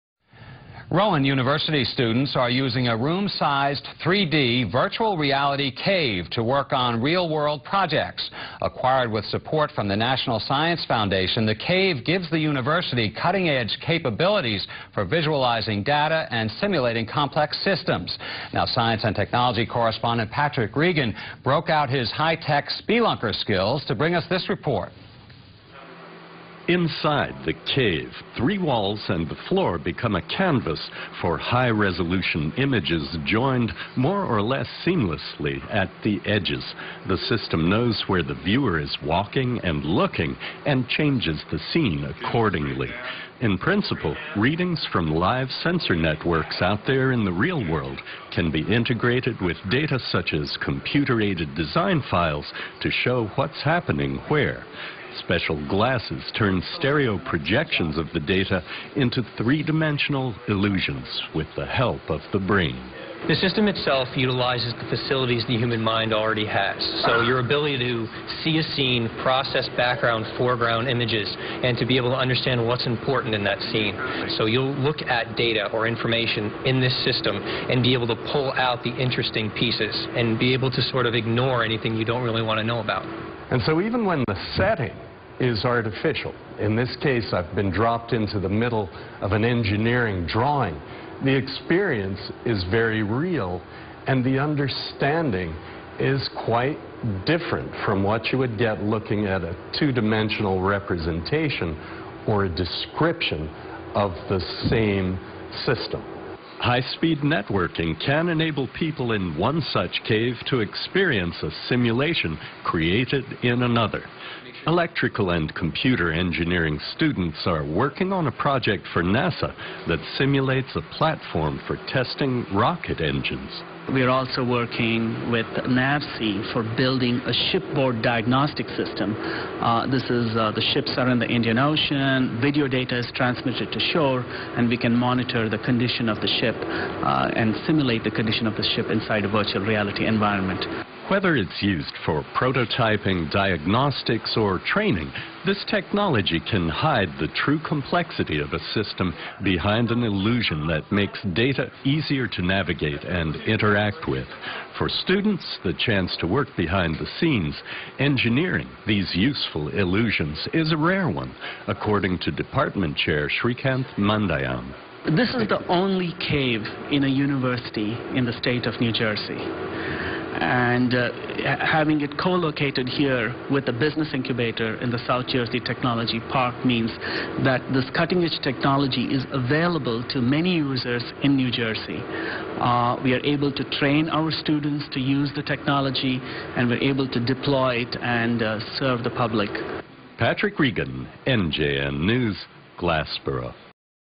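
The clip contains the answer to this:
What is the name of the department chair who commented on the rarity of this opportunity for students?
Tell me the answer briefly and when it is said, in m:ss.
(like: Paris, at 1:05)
Shreekanth Mandayam, at 2:43.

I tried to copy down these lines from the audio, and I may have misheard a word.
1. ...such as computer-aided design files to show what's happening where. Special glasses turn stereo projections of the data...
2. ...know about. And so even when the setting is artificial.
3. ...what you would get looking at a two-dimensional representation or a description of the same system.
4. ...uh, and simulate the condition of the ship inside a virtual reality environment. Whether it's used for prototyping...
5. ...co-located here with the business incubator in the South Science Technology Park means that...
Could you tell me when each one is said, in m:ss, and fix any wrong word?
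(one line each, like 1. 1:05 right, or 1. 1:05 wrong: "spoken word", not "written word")
1. 0:49 right
2. 1:22 right
3. 1:38 right
4. 2:16 right
5. 2:52 wrong: "Jersey", not "Science".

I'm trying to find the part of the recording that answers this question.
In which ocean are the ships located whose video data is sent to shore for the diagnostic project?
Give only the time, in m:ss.
2:11.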